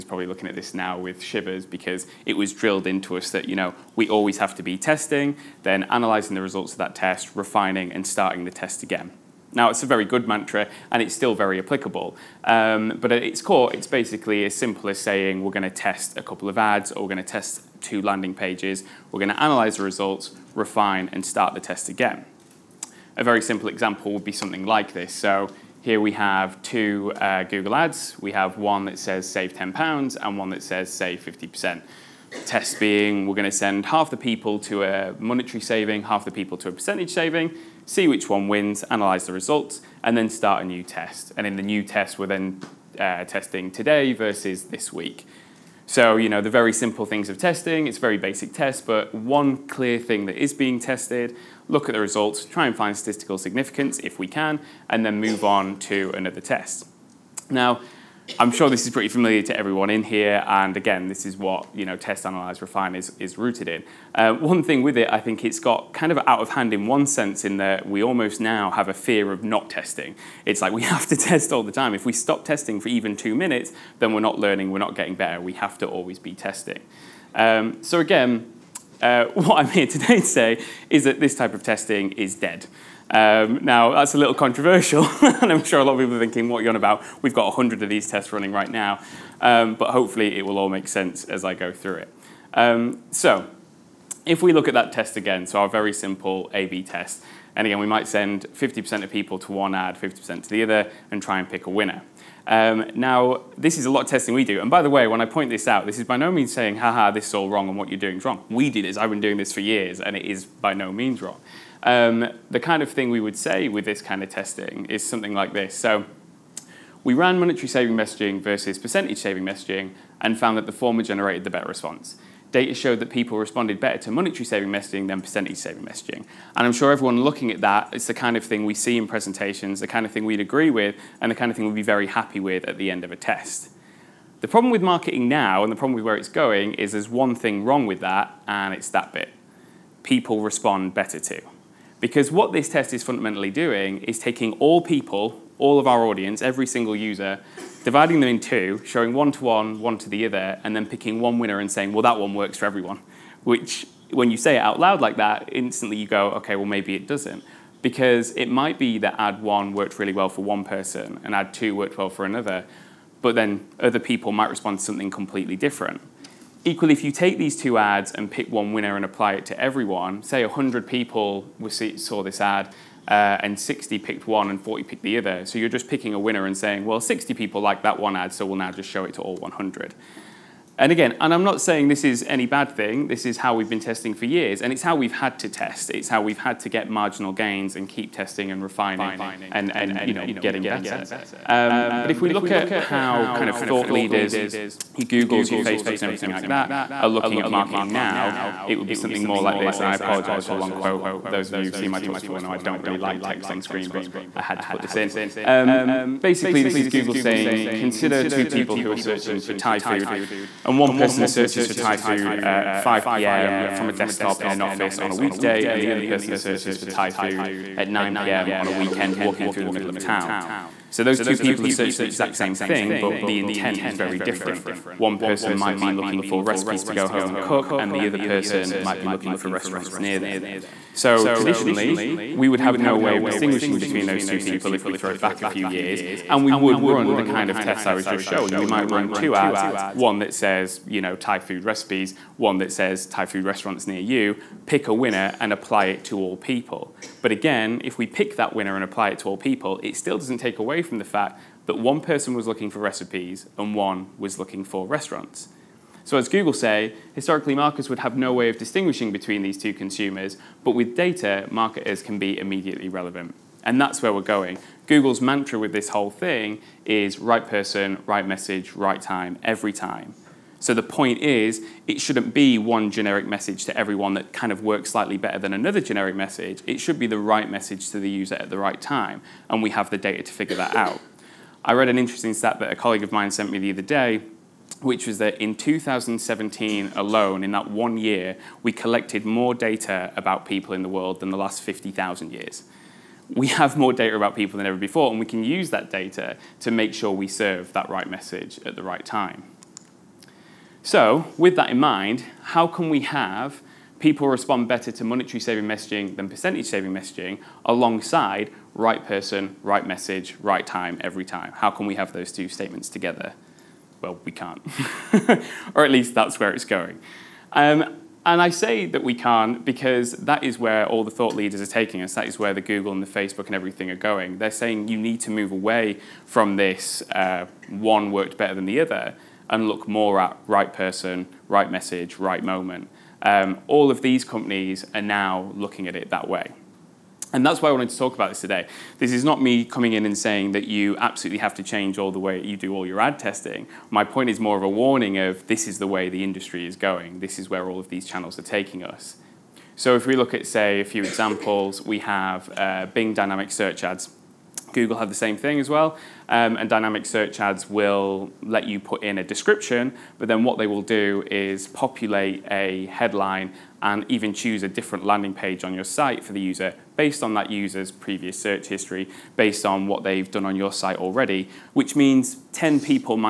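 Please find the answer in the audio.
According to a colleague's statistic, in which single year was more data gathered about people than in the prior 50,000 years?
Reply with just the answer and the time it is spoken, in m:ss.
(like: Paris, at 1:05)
2017, at 4:45.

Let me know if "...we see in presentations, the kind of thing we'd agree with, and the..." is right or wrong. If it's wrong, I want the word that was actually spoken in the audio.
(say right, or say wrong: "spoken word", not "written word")
right.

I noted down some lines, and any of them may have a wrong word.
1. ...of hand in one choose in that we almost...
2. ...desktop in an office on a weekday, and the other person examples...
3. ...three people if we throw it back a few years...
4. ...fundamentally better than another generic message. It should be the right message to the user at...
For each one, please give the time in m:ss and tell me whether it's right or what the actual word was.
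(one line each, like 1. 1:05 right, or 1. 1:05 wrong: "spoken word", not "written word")
1. 1:06 wrong: "sense", not "choose"
2. 3:33 wrong: "searches", not "examples"
3. 3:54 wrong: "two", not "three"
4. 4:34 wrong: "slightly", not "fundamentally".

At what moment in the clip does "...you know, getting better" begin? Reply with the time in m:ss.
3:10.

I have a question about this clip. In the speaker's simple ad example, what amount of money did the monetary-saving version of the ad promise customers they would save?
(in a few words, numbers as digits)
£10.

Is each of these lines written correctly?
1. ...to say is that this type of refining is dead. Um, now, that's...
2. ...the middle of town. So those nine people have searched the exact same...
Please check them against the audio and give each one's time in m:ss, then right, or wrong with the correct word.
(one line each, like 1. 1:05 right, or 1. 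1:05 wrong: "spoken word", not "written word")
1. 1:20 wrong: "testing", not "refining"
2. 3:39 wrong: "two", not "nine".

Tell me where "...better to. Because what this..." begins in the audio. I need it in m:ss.
2:20.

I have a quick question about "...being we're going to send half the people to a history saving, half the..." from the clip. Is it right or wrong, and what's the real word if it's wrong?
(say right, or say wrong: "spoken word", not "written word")
wrong: "monetary", not "history".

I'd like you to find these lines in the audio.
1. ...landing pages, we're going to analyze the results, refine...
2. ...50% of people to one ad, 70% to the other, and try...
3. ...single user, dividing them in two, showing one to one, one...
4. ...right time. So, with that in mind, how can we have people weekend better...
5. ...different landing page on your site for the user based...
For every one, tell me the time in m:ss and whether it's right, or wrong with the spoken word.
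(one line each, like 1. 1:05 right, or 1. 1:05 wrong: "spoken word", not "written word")
1. 0:18 right
2. 1:38 wrong: "50", not "70"
3. 2:26 right
4. 4:58 wrong: "respond", not "weekend"
5. 6:04 right.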